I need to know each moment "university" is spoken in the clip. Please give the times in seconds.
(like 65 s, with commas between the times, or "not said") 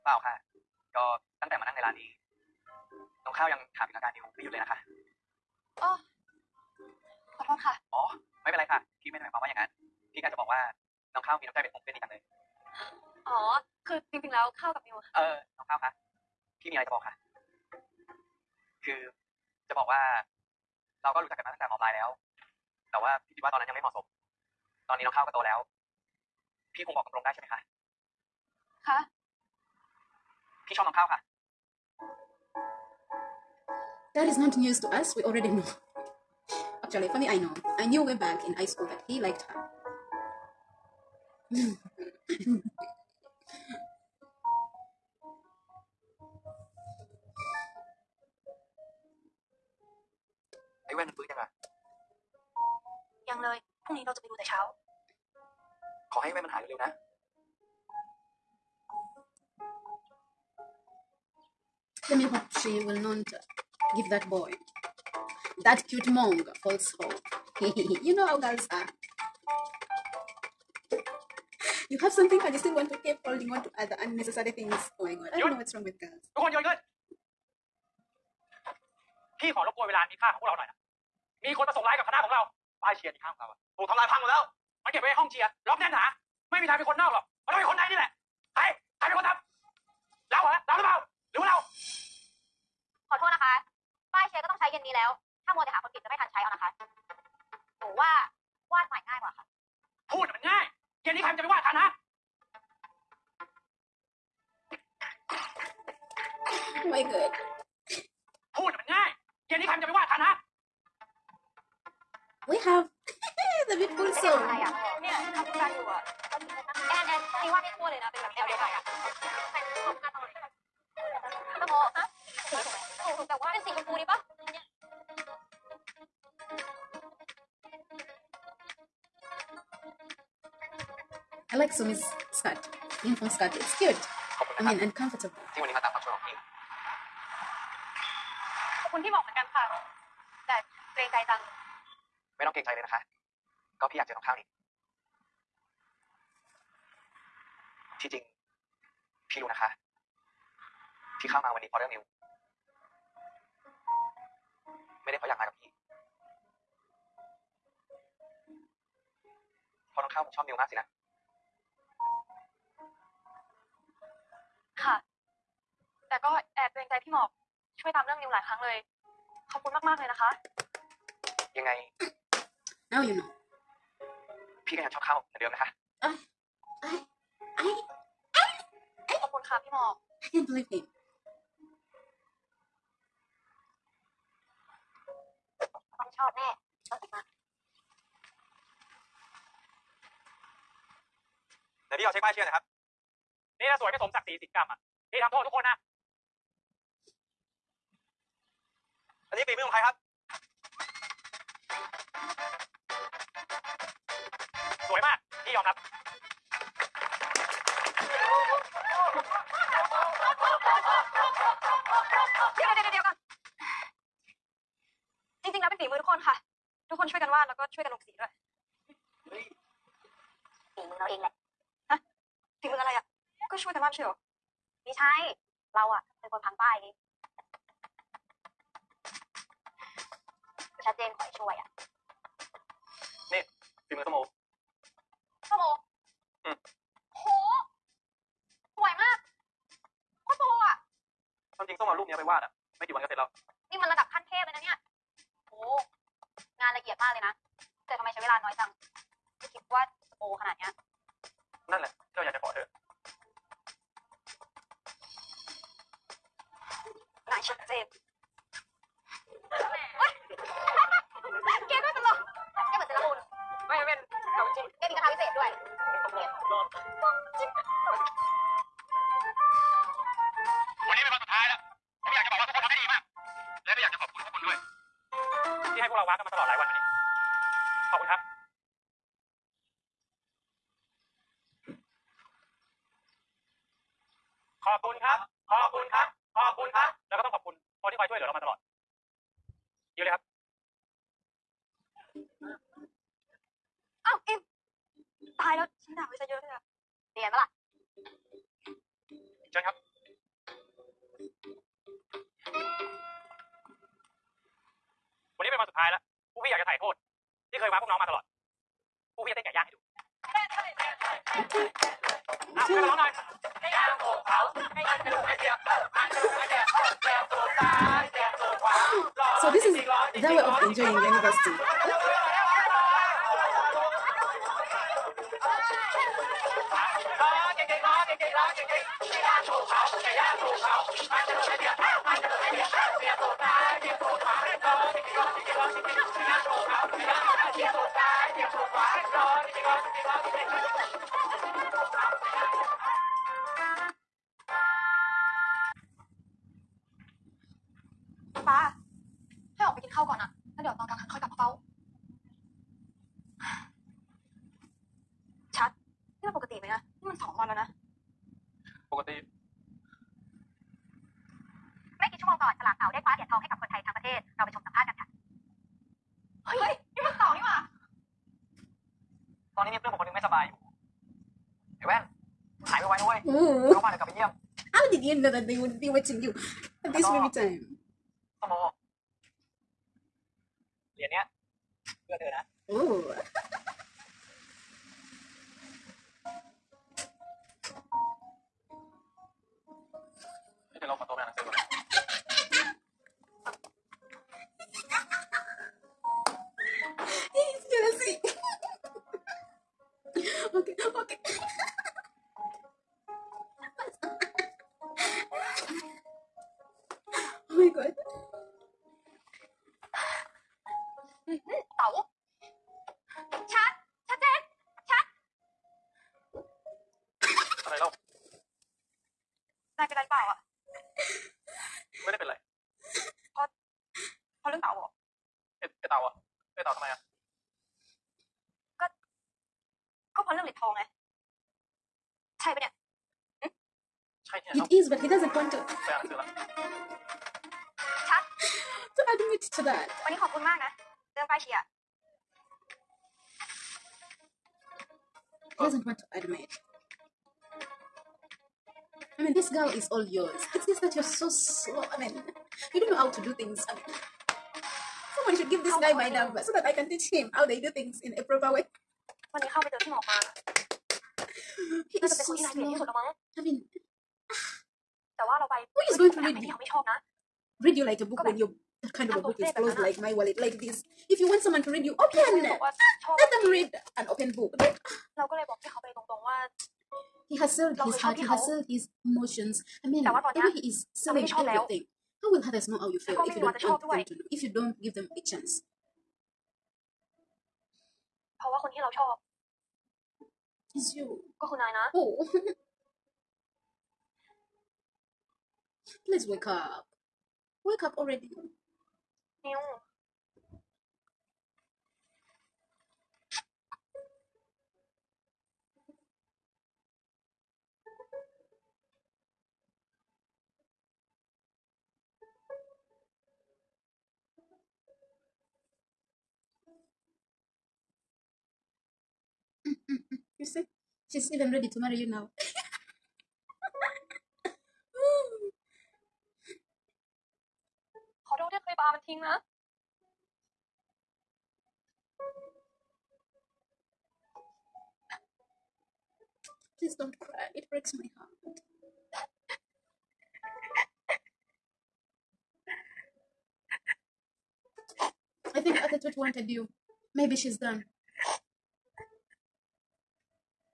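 321 s.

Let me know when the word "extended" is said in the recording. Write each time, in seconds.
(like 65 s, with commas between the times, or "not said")
not said.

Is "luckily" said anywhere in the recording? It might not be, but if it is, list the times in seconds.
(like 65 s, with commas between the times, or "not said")
not said.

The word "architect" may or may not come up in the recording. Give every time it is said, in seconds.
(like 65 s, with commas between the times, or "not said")
not said.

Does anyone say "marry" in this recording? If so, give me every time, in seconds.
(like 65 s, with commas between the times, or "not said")
521 s.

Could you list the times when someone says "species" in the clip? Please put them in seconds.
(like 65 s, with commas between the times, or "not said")
not said.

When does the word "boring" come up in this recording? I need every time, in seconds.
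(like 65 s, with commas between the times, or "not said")
not said.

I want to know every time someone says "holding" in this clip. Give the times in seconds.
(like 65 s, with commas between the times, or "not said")
73 s.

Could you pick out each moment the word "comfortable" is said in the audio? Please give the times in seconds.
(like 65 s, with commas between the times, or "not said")
134 s.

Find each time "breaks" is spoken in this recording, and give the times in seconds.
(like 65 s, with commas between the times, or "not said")
537 s.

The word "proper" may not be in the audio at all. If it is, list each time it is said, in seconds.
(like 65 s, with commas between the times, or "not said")
458 s.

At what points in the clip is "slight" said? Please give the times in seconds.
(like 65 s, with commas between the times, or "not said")
not said.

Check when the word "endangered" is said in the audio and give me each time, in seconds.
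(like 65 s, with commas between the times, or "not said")
not said.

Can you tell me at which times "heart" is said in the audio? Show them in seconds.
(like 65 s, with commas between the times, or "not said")
477 s, 538 s.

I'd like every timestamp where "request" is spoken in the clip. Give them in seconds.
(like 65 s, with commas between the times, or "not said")
not said.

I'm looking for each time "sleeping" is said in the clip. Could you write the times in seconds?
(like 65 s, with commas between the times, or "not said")
not said.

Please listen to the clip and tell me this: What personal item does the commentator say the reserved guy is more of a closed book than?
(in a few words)
wallet.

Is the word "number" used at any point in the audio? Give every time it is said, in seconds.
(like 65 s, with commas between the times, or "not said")
456 s.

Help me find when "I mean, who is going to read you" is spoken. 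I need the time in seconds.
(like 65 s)
462 s.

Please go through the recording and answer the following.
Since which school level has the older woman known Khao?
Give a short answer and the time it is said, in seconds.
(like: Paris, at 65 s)
high school, at 21 s.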